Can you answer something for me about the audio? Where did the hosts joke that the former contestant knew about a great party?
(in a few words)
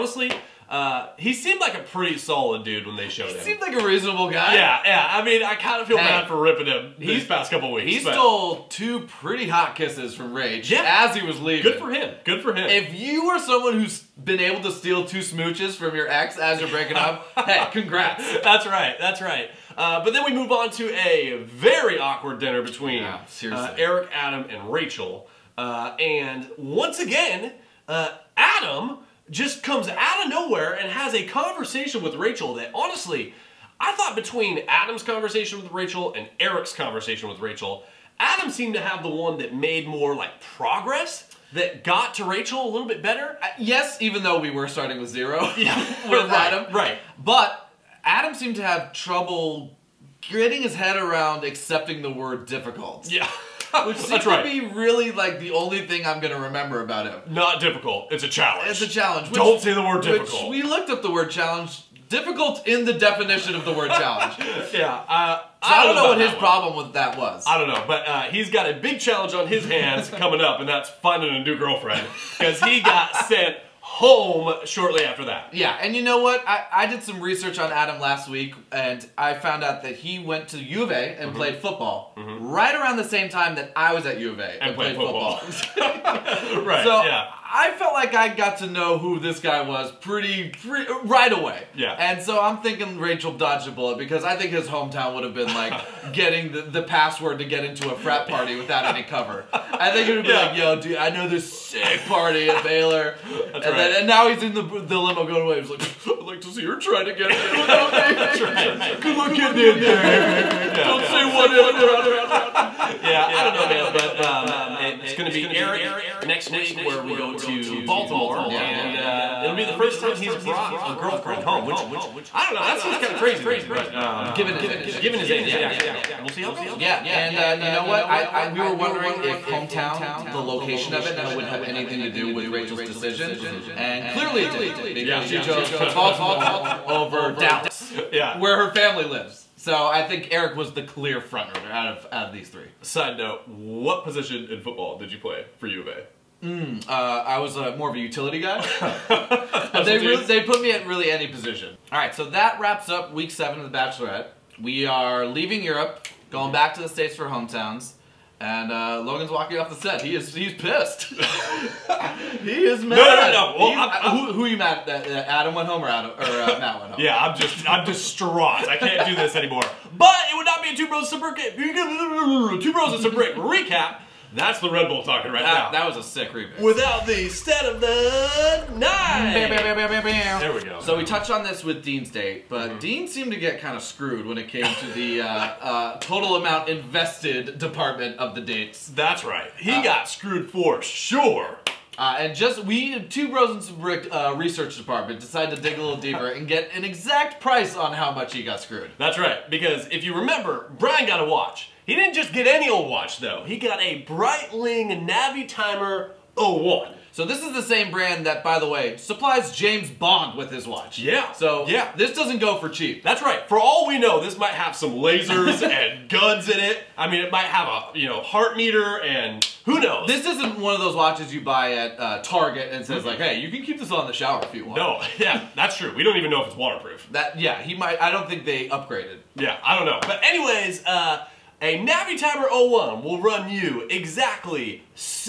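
Baylor.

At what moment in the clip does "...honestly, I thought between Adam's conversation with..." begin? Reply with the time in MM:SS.
00:32.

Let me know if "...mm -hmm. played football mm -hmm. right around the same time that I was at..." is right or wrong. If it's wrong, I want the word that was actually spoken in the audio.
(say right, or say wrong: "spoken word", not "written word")
right.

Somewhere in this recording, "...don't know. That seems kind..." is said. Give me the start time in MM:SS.
02:02.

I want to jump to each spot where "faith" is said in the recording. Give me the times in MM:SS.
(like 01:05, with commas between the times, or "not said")
not said.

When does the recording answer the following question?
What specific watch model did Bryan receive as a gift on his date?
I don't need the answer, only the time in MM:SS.
03:24.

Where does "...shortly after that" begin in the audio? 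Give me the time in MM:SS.
01:14.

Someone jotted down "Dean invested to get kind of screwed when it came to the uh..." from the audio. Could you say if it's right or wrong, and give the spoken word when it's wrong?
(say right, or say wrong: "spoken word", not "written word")
wrong: "seemed", not "invested".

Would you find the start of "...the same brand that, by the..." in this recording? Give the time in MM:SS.
03:27.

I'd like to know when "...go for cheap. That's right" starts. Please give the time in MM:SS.
03:32.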